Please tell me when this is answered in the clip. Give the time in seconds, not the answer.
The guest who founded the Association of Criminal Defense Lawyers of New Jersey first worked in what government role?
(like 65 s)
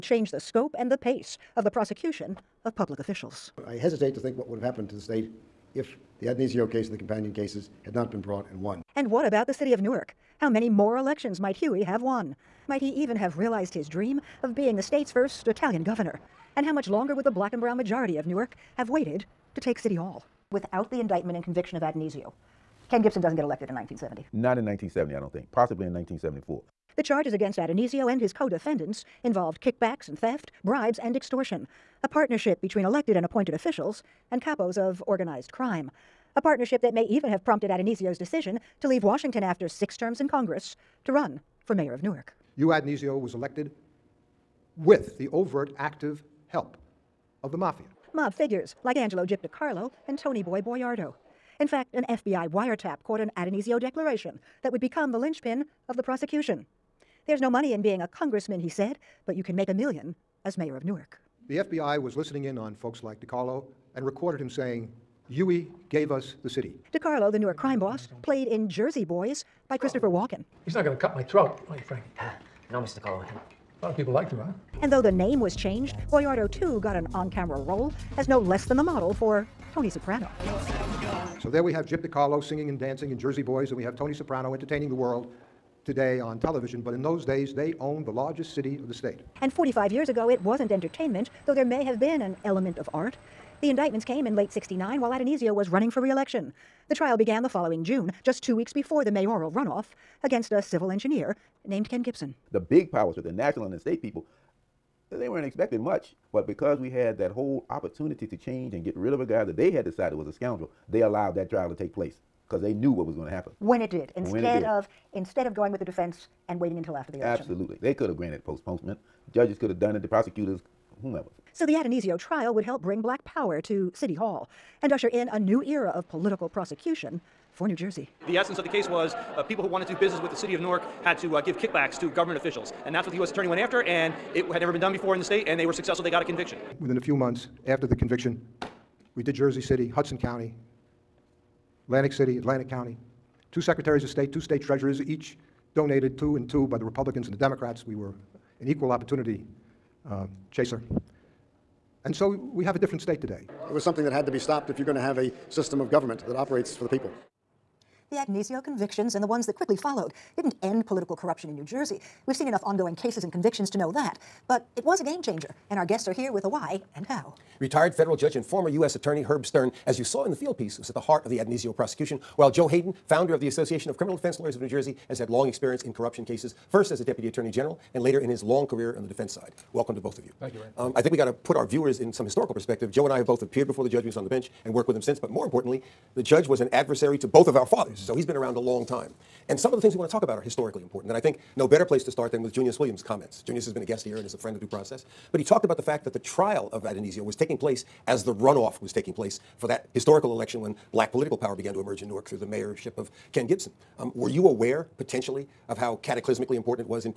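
177 s.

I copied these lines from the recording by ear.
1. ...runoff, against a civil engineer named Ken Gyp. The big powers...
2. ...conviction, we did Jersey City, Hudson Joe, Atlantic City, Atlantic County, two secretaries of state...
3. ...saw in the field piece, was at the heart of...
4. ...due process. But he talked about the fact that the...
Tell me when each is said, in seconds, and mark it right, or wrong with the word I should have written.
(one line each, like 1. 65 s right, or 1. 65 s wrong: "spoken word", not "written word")
1. 99 s wrong: "Gibson", not "Gyp"
2. 137 s wrong: "County", not "Joe"
3. 170 s right
4. 194 s right.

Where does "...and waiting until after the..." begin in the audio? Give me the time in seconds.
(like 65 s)
116 s.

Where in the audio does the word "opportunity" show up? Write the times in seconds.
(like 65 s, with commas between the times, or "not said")
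107 s, 148 s.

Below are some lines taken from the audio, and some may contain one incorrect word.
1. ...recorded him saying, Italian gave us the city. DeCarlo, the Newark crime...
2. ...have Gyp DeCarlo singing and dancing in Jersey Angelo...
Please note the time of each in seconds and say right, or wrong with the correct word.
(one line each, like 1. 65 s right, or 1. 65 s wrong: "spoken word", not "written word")
1. 64 s wrong: "Huey", not "Italian"
2. 81 s wrong: "Boys", not "Angelo".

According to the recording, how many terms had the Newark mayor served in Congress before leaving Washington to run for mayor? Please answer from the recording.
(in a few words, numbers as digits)
6.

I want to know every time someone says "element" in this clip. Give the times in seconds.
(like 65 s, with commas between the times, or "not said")
92 s.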